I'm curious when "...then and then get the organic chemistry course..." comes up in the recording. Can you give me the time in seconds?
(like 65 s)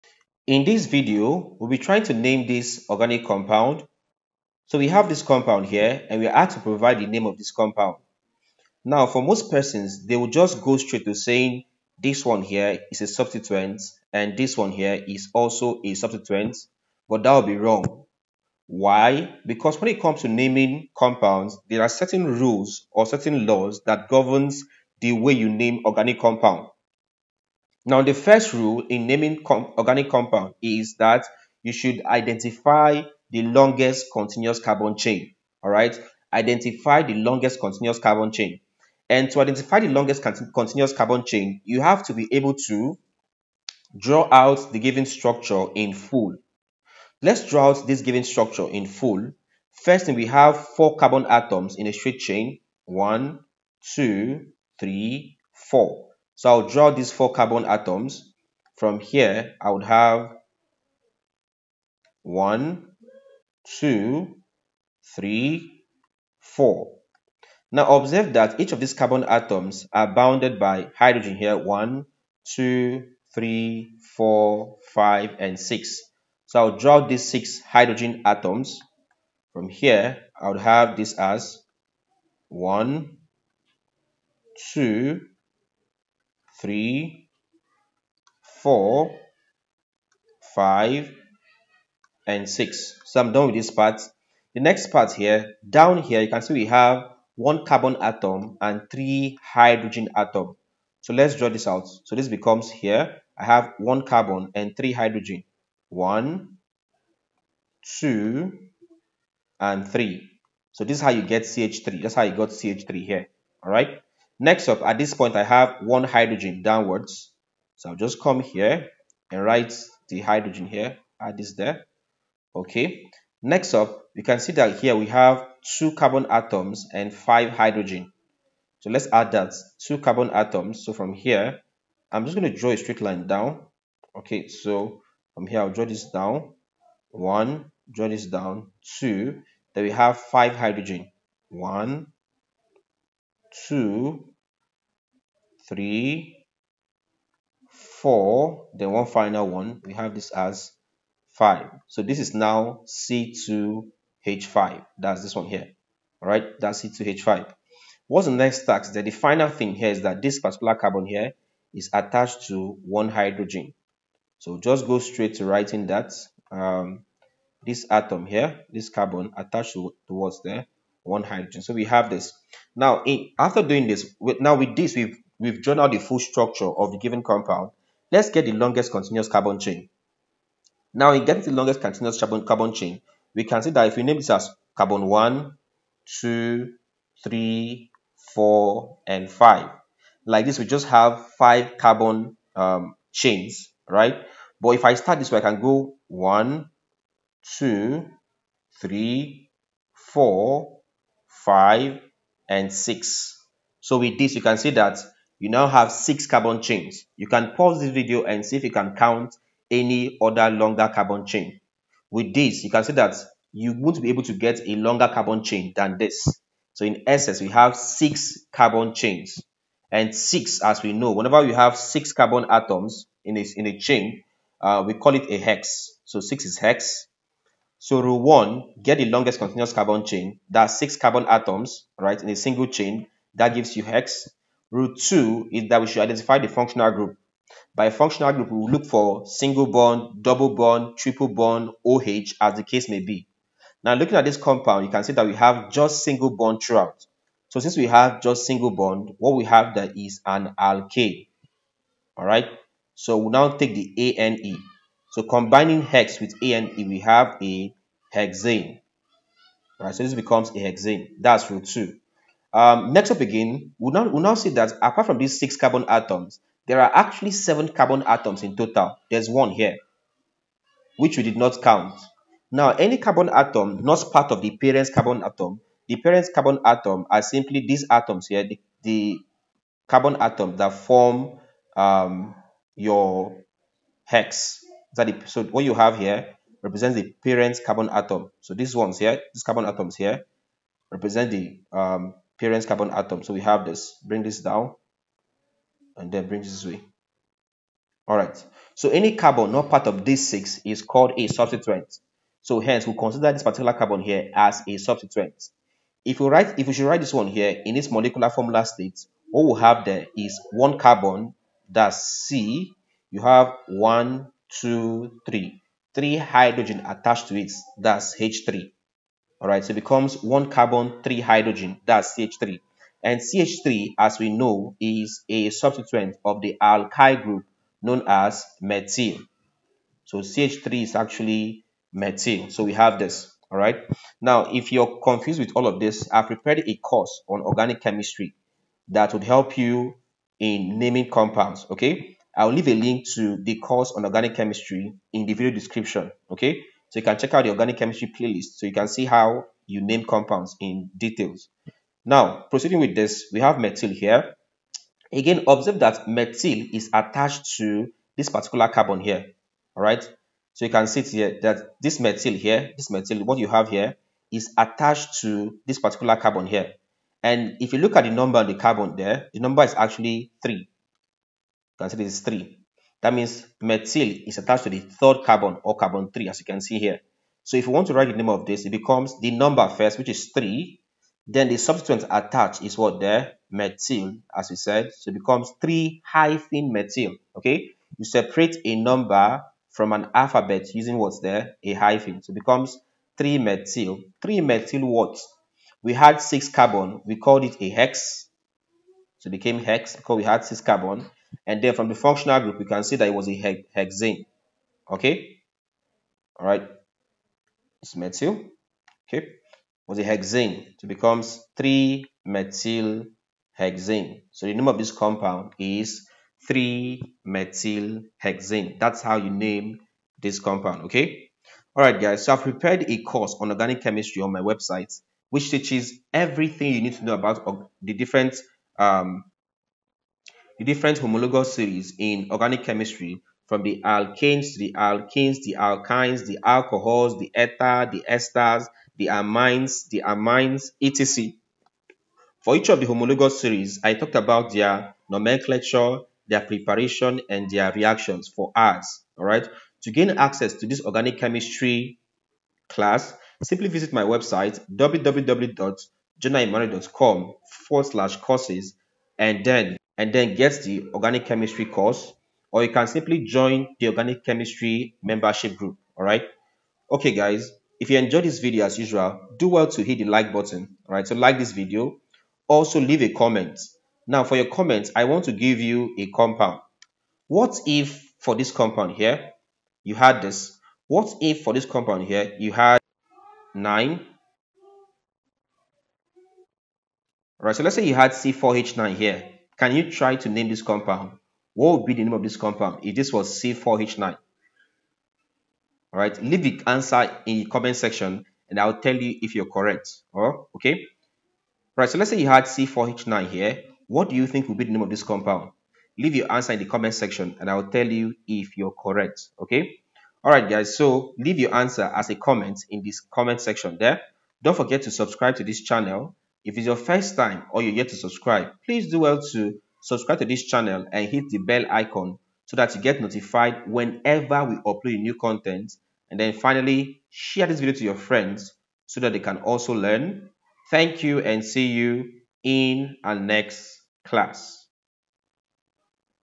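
459 s.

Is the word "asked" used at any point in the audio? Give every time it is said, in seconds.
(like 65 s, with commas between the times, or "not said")
6 s.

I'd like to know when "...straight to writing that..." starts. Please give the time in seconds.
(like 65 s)
164 s.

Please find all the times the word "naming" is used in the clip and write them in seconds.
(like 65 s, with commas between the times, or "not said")
20 s, 29 s, 340 s.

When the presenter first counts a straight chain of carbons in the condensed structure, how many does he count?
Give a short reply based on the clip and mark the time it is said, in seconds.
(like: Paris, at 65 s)
4, at 50 s.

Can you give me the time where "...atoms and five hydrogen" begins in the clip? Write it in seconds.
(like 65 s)
126 s.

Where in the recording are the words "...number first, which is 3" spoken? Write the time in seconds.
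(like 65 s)
379 s.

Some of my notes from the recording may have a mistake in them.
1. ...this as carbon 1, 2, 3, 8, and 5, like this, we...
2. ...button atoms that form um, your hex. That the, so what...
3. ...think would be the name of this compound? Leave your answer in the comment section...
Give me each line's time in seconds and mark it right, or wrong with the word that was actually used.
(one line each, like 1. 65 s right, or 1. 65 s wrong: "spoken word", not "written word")
1. 184 s wrong: "4", not "8"
2. 279 s wrong: "carbon", not "button"
3. 504 s right.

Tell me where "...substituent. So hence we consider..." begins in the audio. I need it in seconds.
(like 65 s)
301 s.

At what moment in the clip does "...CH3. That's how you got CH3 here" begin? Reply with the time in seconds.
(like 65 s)
111 s.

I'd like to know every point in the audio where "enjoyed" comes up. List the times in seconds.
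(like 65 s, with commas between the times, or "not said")
467 s.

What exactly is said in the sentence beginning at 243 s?
Now, looking at this compound, you can see that we have just single bond throughout.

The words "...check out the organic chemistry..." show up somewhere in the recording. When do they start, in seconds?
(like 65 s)
347 s.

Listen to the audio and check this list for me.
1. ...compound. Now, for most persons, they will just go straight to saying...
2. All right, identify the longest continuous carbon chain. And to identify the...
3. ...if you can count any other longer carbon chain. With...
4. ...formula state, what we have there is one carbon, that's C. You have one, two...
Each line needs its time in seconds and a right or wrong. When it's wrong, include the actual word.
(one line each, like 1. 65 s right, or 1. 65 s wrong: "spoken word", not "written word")
1. 7 s right
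2. 35 s right
3. 208 s right
4. 308 s right.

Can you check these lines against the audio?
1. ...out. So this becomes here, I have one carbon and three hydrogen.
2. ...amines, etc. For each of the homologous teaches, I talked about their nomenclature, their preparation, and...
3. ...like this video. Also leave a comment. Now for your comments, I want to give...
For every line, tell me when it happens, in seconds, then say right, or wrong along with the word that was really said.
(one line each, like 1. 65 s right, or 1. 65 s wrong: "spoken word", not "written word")
1. 101 s right
2. 440 s wrong: "series", not "teaches"
3. 471 s right.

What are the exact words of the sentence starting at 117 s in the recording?
So I'll just come here and write the hydrogen here, add this there.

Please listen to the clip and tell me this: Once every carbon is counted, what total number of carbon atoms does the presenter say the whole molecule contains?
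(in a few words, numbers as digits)
7.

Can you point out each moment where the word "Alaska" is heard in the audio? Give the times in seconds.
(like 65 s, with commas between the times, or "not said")
not said.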